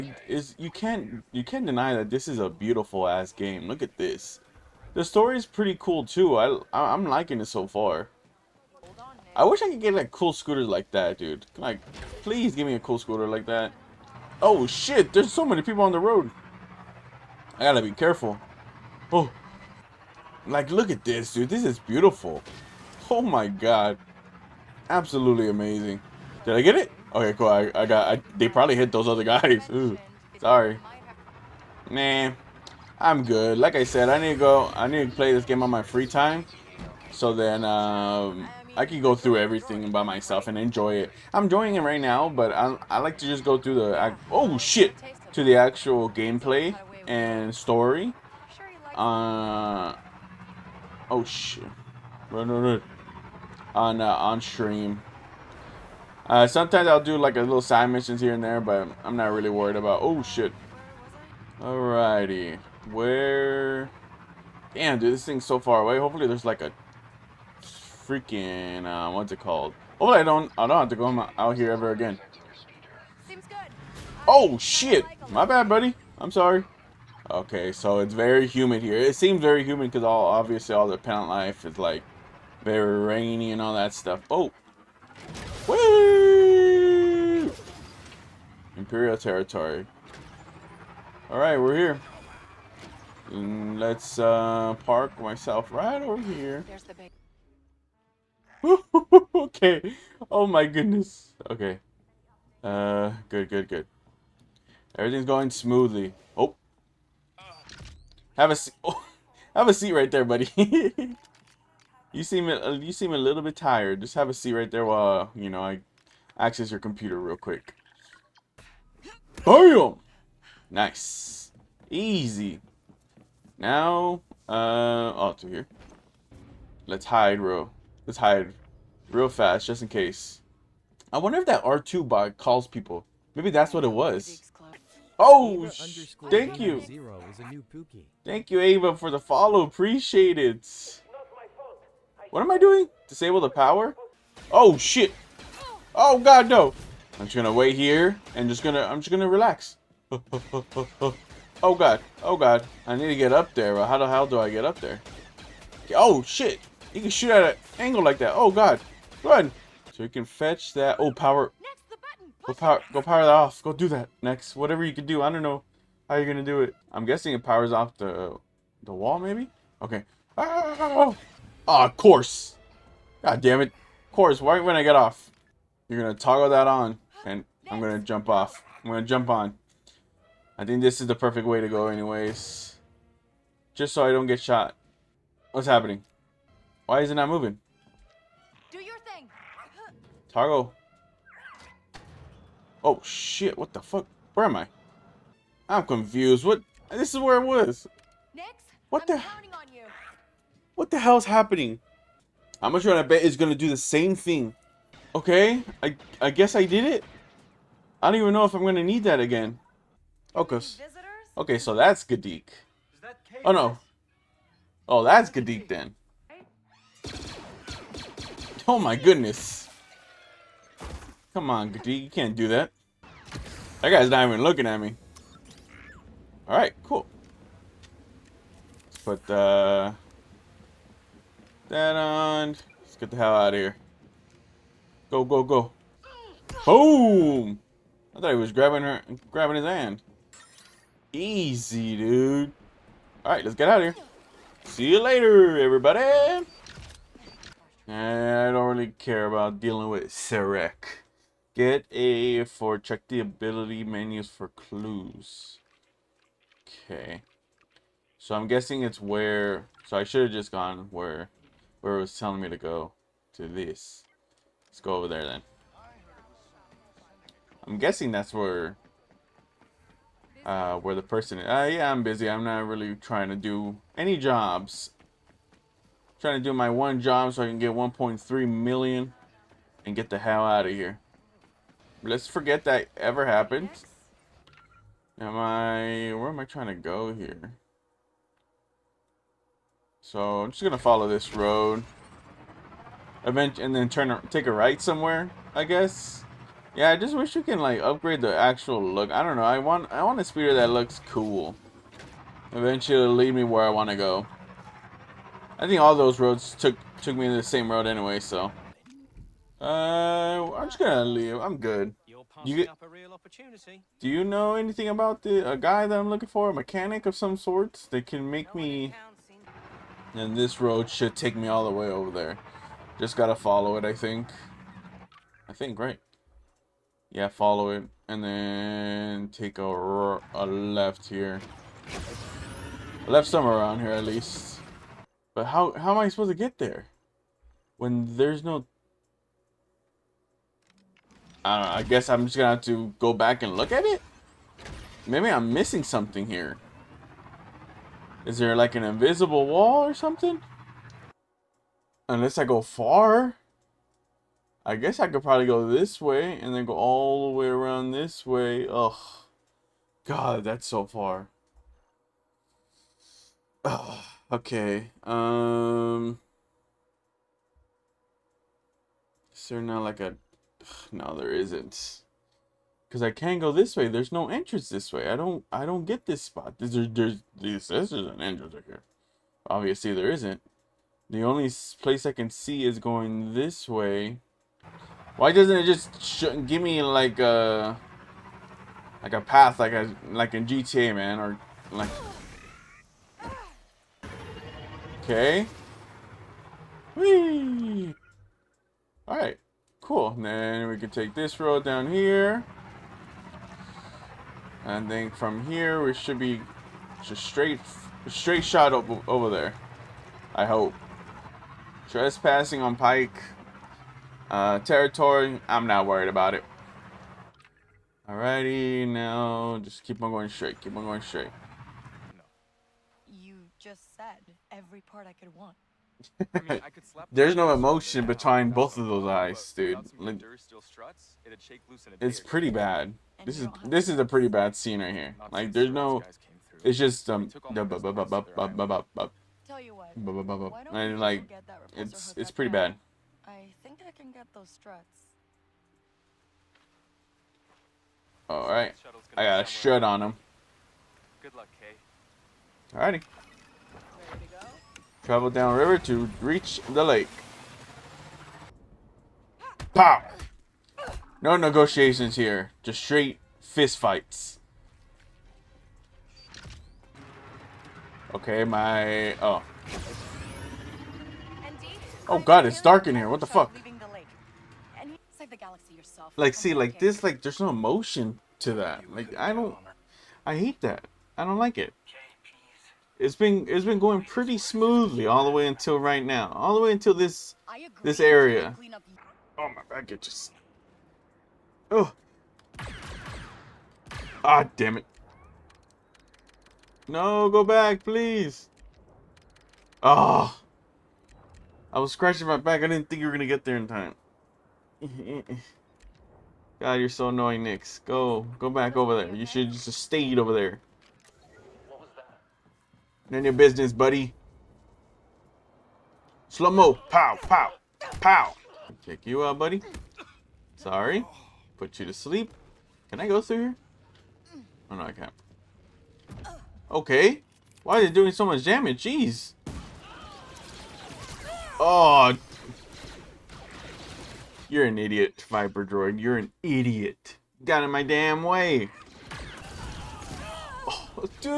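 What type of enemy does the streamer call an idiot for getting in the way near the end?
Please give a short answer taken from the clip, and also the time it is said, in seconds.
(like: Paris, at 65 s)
Viper Droid, at 535 s.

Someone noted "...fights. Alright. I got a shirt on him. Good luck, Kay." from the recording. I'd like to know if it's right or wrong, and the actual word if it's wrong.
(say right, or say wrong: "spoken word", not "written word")
wrong: "struts", not "fights".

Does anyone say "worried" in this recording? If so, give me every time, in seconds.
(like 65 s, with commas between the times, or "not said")
59 s, 415 s.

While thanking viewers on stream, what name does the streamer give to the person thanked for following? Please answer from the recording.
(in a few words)
Ava.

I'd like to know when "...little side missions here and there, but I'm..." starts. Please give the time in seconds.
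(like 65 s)
57 s.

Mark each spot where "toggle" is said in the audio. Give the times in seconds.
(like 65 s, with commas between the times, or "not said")
176 s, 190 s.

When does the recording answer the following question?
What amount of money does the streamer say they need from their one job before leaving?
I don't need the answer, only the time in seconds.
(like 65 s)
277 s.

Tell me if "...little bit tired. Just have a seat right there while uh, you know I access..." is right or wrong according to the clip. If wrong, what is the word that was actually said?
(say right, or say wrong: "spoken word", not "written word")
right.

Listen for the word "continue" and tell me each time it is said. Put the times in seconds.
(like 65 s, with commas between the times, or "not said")
not said.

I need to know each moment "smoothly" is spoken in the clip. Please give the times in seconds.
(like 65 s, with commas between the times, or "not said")
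105 s, 484 s.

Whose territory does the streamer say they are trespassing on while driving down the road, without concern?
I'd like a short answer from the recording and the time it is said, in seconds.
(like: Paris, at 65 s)
Pike, at 412 s.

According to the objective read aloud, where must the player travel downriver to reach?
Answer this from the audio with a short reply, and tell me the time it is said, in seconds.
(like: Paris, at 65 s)
the lake, at 456 s.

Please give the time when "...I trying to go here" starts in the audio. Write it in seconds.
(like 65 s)
286 s.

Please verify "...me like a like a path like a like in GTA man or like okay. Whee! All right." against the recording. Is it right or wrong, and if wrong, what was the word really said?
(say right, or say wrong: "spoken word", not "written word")
right.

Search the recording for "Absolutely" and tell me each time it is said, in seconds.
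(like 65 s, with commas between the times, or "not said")
24 s.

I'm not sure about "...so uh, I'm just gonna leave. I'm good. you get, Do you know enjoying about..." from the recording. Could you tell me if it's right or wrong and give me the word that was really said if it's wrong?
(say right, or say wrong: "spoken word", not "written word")
wrong: "anything", not "enjoying".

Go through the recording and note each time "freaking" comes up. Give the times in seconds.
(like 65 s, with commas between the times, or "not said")
67 s.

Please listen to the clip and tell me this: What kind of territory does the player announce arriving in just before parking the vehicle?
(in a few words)
Imperial territory.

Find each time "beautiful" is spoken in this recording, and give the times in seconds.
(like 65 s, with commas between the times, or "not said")
2 s, 21 s.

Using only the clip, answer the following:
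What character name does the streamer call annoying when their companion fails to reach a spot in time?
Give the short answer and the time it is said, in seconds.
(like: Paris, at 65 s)
Nix, at 507 s.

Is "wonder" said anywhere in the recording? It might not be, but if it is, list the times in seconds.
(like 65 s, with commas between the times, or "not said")
131 s.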